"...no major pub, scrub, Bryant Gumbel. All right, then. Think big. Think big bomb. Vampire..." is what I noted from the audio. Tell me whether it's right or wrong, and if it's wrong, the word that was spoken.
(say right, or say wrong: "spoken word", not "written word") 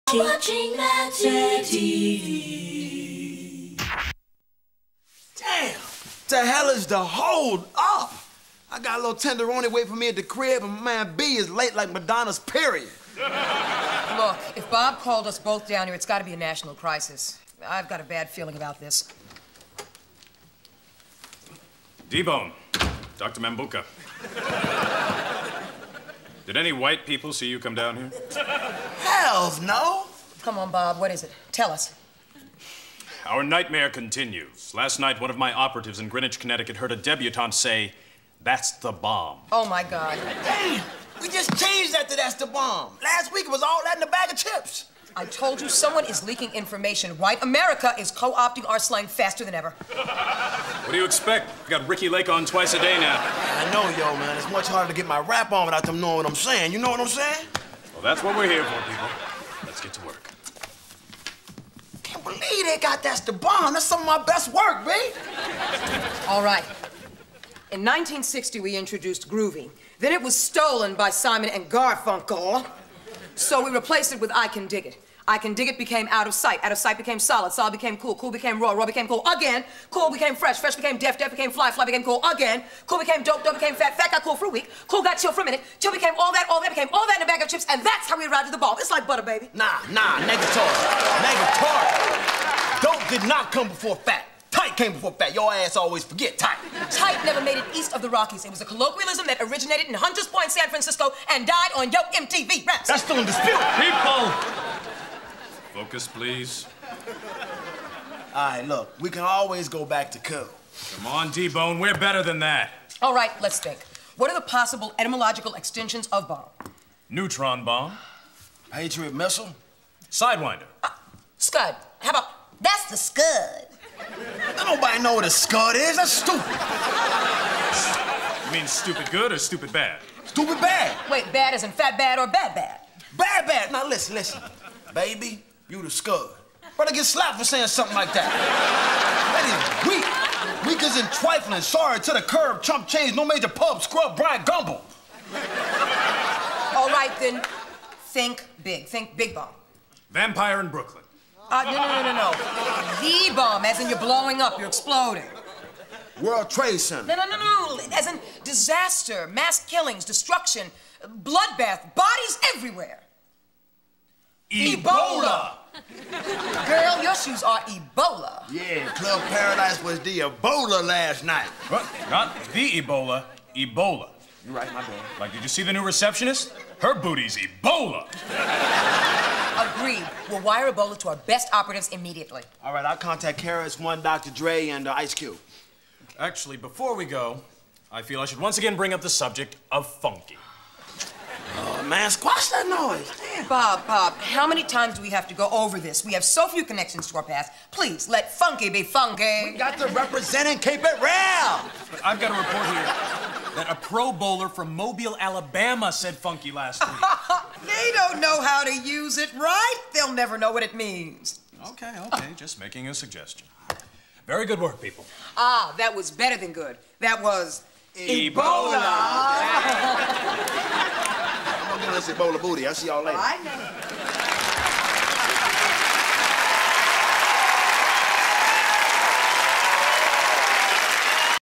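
right.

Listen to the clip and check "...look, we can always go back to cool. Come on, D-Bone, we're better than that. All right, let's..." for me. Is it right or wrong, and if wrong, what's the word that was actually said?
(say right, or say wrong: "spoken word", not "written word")
right.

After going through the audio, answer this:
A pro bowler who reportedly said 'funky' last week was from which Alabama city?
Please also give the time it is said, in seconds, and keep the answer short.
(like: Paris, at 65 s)
Mobile, at 204 s.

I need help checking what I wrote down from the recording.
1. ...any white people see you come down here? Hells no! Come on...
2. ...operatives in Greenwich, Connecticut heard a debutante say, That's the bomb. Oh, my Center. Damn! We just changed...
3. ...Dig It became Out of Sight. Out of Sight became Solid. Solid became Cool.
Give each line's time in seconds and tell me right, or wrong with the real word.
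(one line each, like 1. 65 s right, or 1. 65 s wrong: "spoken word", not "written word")
1. 26 s right
2. 35 s wrong: "God", not "Center"
3. 75 s right.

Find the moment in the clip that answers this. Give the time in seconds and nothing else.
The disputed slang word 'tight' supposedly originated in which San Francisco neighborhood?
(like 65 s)
99 s.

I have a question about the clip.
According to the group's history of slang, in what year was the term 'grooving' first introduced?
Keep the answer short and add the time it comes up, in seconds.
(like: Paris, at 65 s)
1960, at 67 s.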